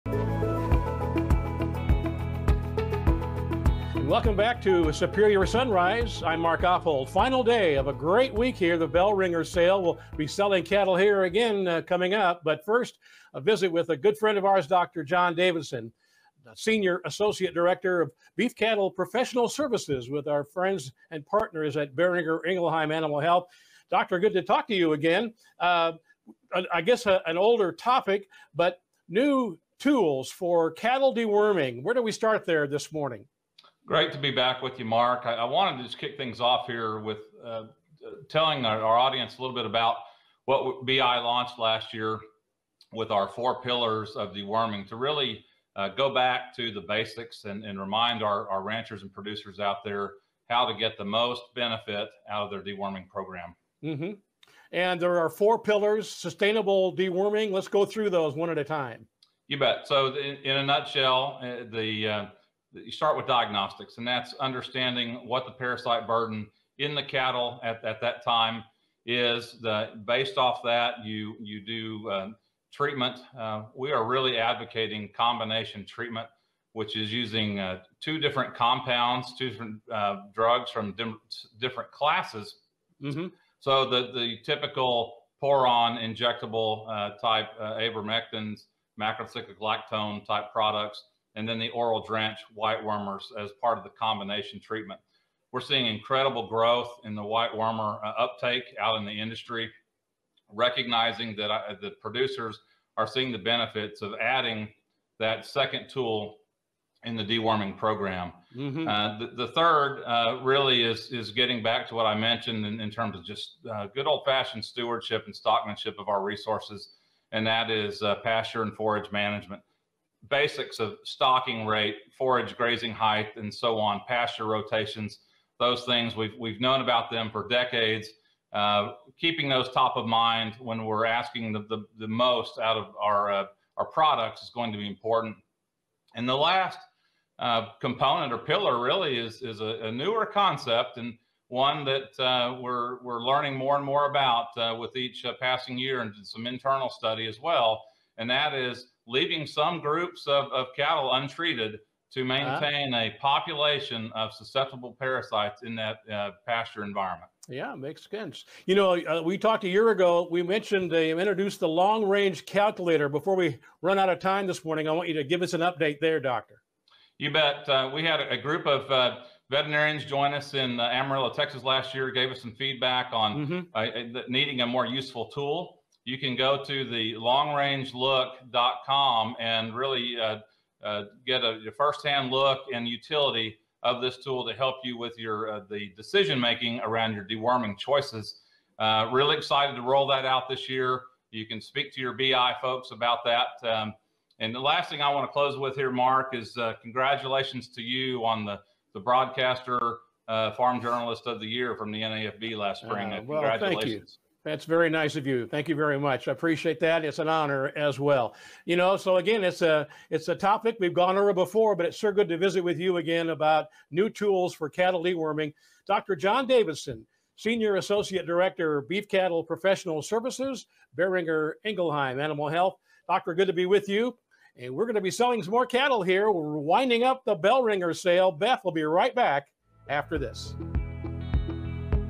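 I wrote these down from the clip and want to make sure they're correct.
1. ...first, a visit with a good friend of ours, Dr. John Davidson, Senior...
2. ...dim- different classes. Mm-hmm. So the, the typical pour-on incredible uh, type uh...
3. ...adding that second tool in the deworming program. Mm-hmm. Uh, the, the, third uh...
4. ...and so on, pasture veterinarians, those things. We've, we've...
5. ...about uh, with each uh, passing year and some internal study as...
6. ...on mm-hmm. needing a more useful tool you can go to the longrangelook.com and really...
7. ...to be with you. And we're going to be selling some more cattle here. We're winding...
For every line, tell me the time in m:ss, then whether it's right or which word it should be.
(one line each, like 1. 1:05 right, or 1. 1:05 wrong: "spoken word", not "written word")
1. 0:12 right
2. 1:20 wrong: "injectable", not "incredible"
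3. 1:44 right
4. 2:03 wrong: "rotations", not "veterinarians"
5. 2:24 right
6. 2:53 right
7. 3:43 right.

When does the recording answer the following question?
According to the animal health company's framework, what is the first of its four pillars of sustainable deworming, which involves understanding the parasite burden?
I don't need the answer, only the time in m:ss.
1:03.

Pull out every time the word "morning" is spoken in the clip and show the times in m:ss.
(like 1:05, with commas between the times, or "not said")
0:32, 2:44.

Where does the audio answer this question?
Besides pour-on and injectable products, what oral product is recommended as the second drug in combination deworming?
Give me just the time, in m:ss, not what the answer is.
1:32.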